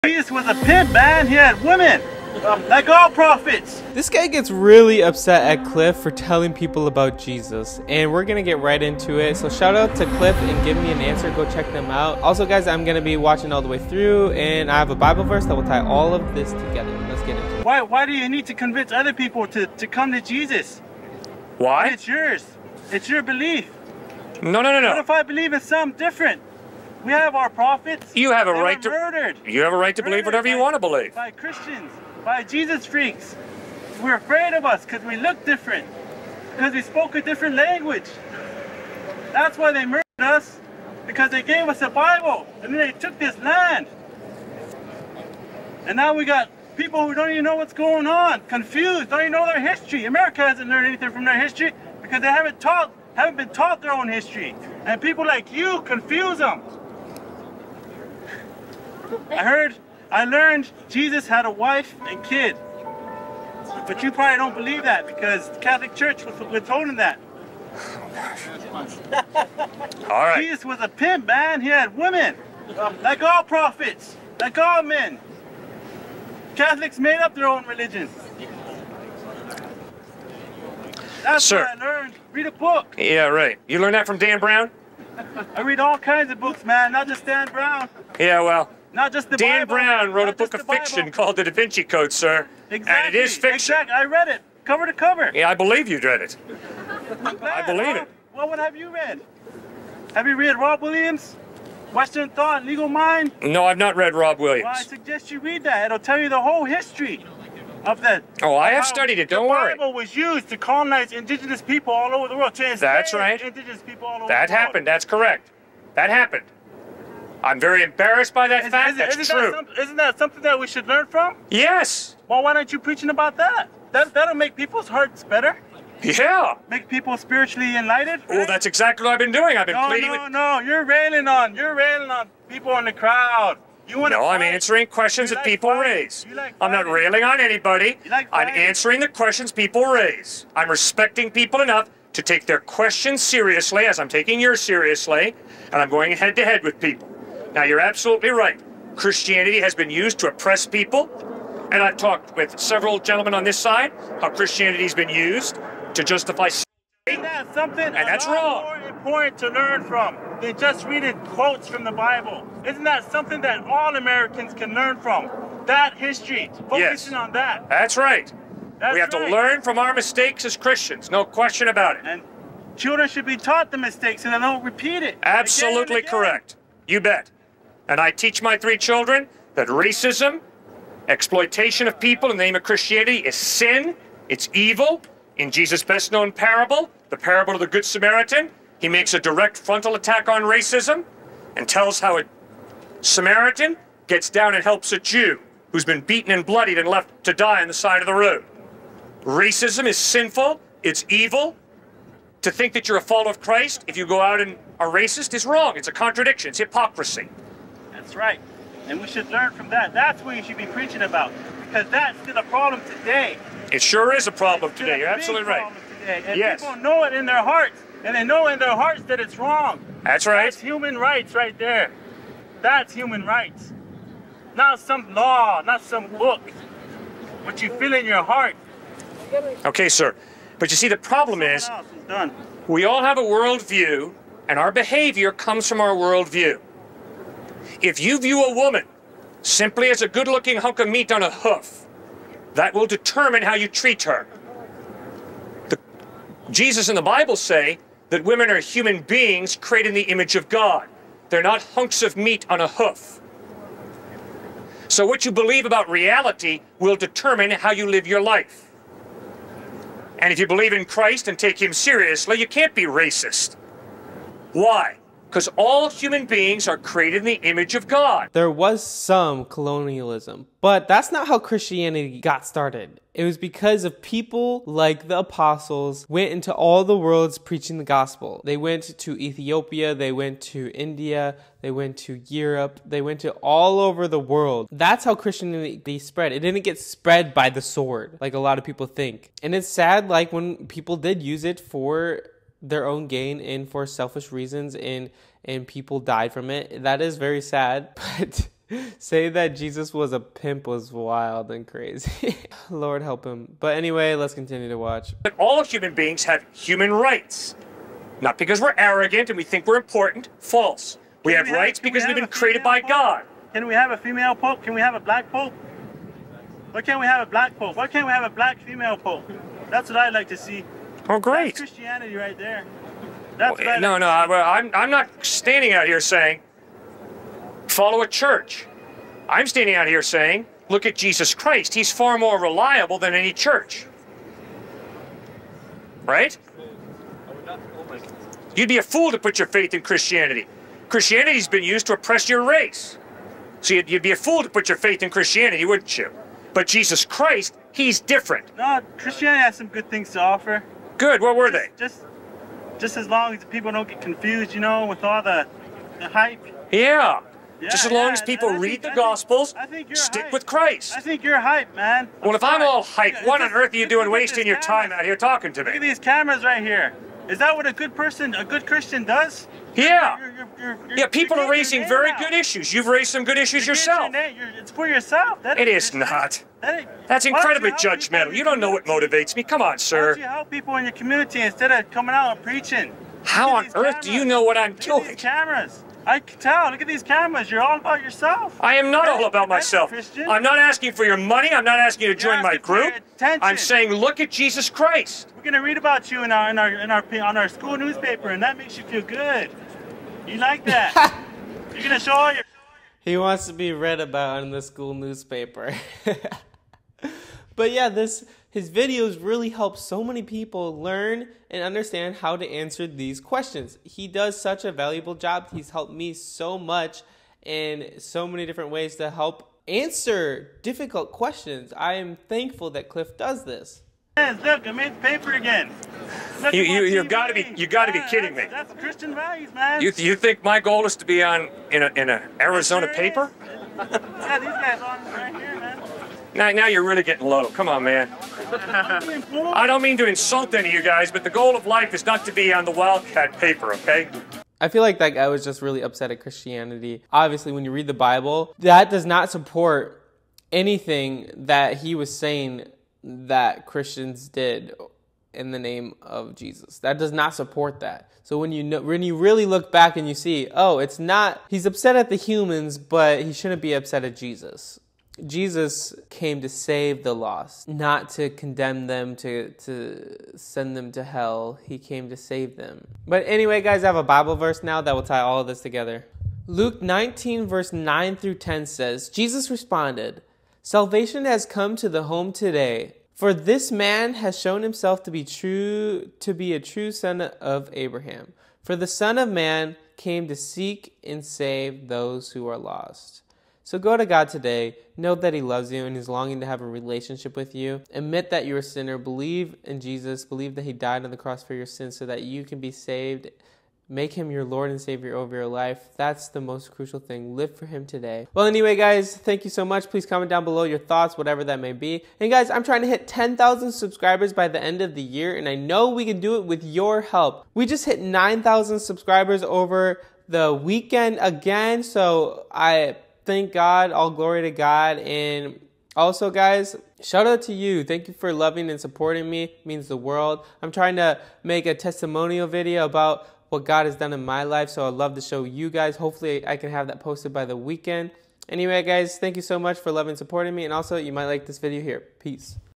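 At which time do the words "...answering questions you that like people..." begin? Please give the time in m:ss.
2:14.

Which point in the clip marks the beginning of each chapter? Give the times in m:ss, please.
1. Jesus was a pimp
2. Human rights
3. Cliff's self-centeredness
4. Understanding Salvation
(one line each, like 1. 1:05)
1. 1:00
2. 5:00
3. 7:20
4. 7:53.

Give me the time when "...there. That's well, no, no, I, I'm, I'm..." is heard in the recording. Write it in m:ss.
5:22.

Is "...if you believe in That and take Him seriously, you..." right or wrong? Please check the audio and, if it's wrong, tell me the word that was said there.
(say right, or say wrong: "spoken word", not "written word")
wrong: "Christ", not "That".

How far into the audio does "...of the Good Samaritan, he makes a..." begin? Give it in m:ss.
3:07.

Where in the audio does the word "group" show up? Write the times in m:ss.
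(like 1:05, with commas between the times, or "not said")
6:32.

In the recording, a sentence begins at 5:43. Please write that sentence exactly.
So you'd, you'd be a fool to put your faith in Christianity, wouldn't you?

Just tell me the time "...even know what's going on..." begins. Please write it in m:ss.
0:47.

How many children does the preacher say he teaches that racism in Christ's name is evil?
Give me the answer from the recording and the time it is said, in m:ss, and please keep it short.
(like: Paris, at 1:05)
3, at 2:58.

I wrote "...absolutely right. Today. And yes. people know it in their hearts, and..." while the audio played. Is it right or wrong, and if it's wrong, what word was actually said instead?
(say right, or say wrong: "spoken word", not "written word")
right.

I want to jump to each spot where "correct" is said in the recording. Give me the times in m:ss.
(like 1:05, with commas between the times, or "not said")
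1:55, 2:56.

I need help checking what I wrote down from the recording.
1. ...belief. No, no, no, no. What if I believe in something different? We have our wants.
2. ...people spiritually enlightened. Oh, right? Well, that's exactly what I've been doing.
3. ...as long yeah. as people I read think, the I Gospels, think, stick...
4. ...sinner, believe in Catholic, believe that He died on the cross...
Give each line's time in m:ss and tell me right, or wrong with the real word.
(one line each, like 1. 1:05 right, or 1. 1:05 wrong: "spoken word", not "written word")
1. 0:23 wrong: "prophets", not "wants"
2. 2:06 right
3. 5:57 right
4. 8:18 wrong: "Jesus", not "Catholic".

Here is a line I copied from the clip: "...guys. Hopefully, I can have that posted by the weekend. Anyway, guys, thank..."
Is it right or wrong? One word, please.
right.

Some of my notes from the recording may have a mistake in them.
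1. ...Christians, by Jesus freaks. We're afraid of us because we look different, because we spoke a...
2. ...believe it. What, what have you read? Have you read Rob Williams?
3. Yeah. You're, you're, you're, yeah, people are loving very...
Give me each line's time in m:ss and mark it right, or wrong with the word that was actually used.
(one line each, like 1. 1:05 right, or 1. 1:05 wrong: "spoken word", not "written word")
1. 0:31 right
2. 1:37 right
3. 6:09 wrong: "raising", not "loving".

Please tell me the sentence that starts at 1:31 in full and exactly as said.
called The Da Vinci Code, sir.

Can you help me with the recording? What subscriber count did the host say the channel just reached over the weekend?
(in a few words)
9,000.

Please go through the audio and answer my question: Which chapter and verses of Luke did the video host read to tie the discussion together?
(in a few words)
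Luke 19:9-10.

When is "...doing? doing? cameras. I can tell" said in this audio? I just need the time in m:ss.
6:24.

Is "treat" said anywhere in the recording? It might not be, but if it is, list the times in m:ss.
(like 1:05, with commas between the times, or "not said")
4:03.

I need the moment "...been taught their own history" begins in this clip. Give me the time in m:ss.
0:53.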